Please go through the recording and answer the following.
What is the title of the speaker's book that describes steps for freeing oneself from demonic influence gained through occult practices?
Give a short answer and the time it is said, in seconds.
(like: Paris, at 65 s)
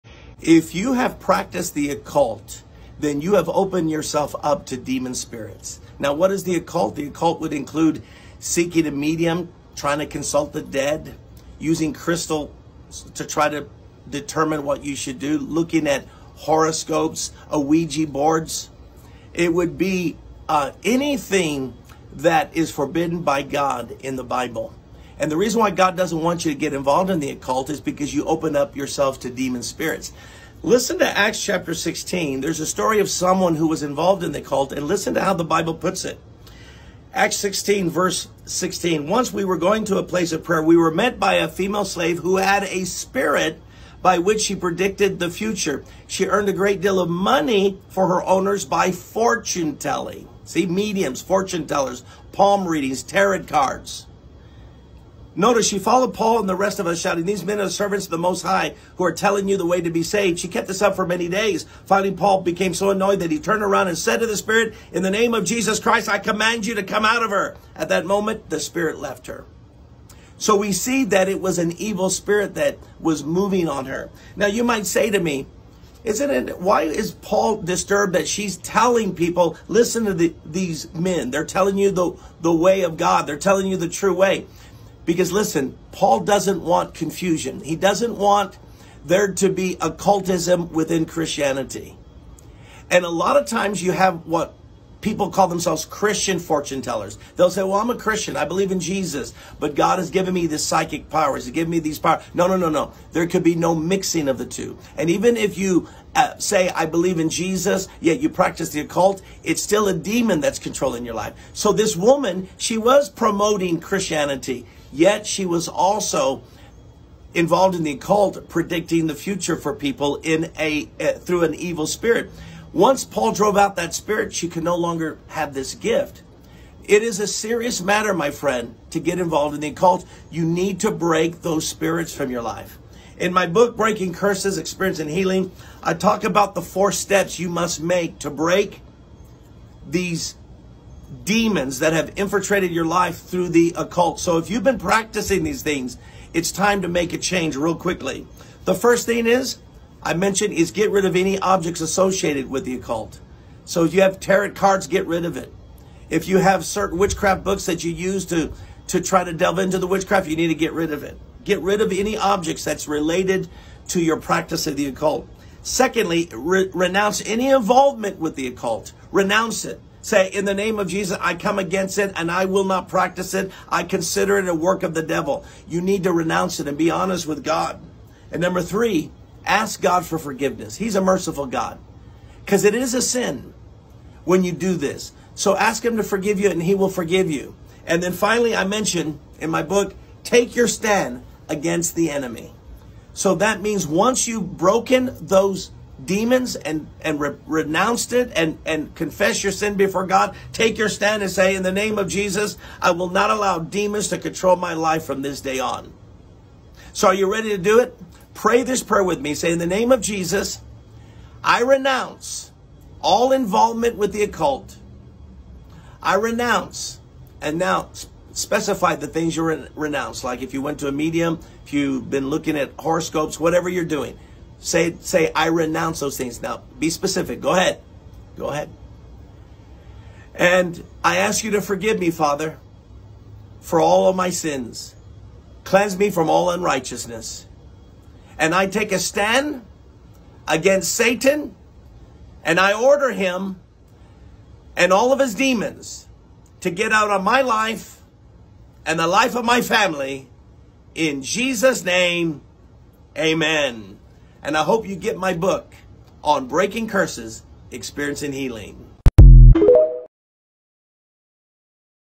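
Breaking Curses, Experience and Healing, at 133 s.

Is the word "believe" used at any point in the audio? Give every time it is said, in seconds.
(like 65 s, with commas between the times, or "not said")
98 s, 106 s.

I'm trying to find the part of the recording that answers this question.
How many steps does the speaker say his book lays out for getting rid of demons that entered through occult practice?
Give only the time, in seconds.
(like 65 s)
136 s.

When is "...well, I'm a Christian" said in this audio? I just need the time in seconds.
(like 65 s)
97 s.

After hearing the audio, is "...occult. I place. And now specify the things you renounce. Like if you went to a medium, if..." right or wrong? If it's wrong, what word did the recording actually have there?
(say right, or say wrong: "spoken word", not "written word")
wrong: "renounce", not "place".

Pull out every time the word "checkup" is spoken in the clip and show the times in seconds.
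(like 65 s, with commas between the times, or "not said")
not said.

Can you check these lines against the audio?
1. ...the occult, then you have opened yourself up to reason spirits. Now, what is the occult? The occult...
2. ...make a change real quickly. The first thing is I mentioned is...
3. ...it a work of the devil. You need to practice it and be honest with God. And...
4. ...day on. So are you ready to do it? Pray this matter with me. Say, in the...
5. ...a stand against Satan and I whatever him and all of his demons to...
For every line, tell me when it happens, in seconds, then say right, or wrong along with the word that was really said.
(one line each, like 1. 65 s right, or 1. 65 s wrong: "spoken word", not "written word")
1. 1 s wrong: "demon", not "reason"
2. 146 s right
3. 174 s wrong: "renounce", not "practice"
4. 205 s wrong: "prayer", not "matter"
5. 238 s wrong: "order", not "whatever".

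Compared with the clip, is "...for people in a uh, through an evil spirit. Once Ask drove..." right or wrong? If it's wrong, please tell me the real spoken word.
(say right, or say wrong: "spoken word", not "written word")
wrong: "Paul", not "Ask".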